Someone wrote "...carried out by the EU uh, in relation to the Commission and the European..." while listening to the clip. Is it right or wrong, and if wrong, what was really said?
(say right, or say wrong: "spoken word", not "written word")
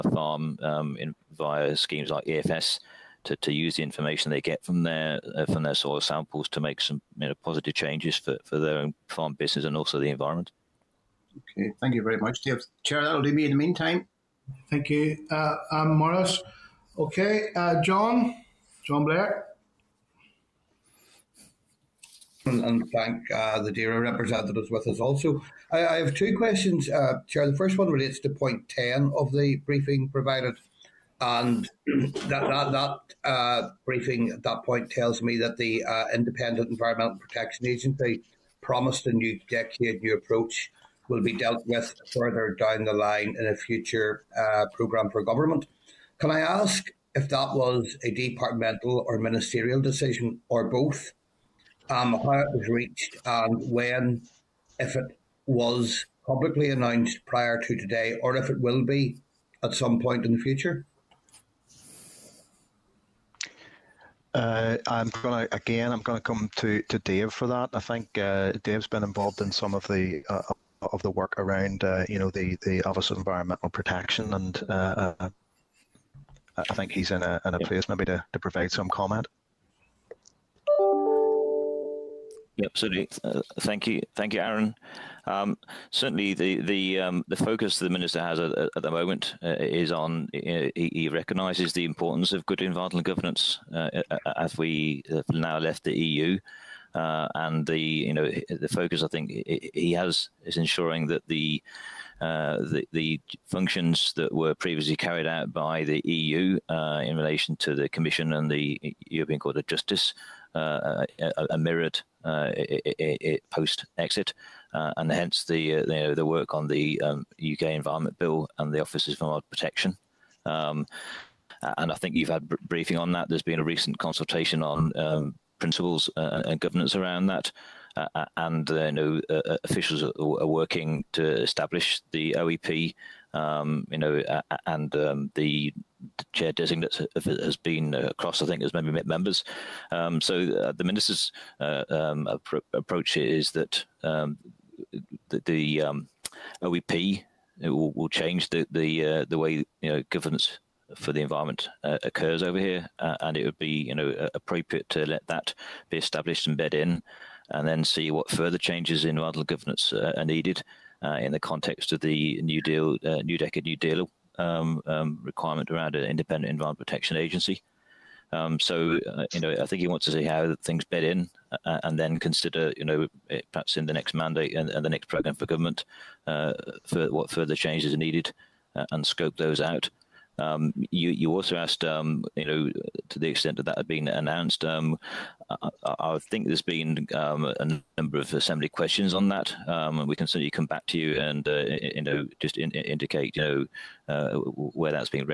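right.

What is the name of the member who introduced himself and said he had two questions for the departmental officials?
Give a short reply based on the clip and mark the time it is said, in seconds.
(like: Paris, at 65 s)
John Blair, at 18 s.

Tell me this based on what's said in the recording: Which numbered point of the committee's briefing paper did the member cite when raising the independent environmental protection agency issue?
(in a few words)
10.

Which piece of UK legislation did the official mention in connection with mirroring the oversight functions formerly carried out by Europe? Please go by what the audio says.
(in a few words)
UK Environment Bill.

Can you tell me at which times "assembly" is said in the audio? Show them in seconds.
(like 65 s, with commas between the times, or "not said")
188 s.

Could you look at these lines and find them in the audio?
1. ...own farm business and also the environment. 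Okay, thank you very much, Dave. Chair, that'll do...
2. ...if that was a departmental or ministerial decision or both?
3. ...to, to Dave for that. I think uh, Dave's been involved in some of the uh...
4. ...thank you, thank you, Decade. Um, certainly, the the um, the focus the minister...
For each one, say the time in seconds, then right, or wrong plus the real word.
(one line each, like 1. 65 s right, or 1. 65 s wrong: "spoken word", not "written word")
1. 8 s right
2. 47 s right
3. 66 s right
4. 83 s wrong: "Aaron", not "Decade".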